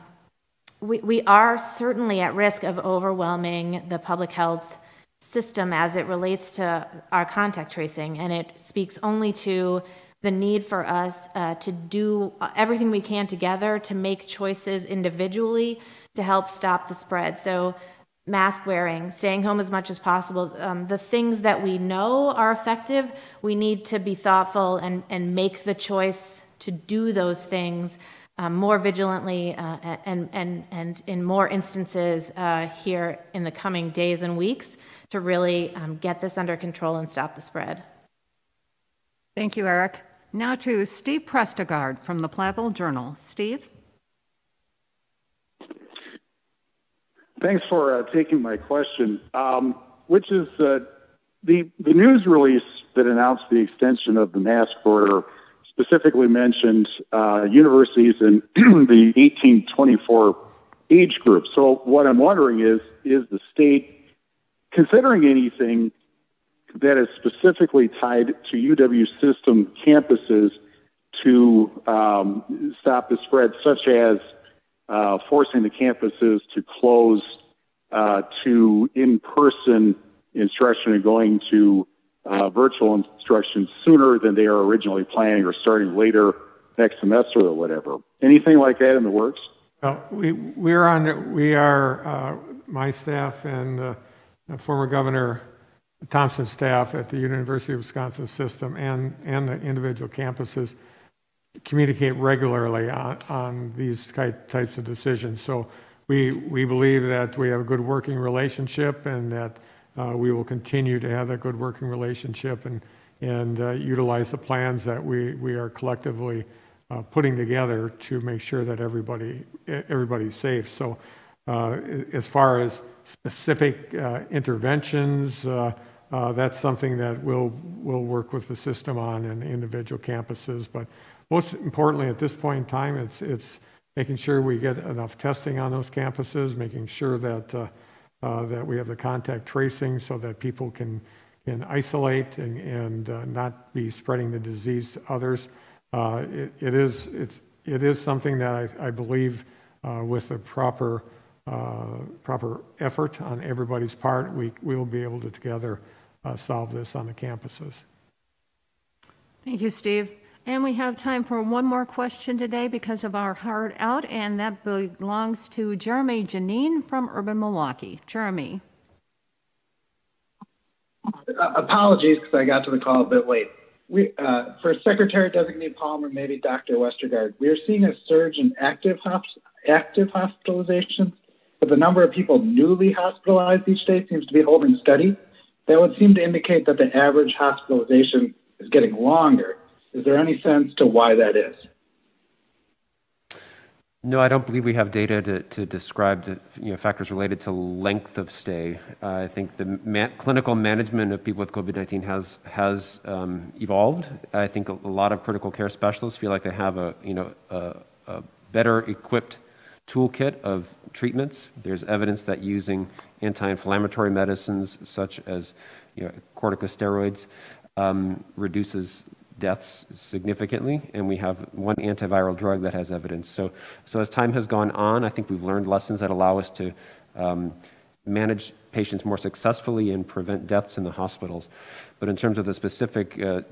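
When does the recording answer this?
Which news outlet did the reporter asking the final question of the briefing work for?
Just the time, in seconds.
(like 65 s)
167 s.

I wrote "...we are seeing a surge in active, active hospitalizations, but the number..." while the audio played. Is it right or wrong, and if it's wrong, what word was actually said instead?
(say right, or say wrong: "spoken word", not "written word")
right.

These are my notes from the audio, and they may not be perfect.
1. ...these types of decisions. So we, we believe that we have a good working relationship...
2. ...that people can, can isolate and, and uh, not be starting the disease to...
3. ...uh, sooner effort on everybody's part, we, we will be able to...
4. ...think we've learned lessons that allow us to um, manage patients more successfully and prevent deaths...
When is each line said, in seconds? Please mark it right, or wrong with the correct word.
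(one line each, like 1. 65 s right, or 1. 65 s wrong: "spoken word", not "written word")
1. 103 s right
2. 140 s wrong: "spreading", not "starting"
3. 151 s wrong: "proper", not "sooner"
4. 225 s right.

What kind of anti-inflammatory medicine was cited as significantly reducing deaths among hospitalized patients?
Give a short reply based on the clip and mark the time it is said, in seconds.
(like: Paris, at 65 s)
Corticosteroids, at 216 s.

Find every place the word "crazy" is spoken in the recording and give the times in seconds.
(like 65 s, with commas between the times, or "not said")
not said.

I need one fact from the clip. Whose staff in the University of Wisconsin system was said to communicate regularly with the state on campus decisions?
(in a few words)
Former Governor Thompson.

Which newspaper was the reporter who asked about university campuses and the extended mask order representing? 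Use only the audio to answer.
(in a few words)
Platteville Journal.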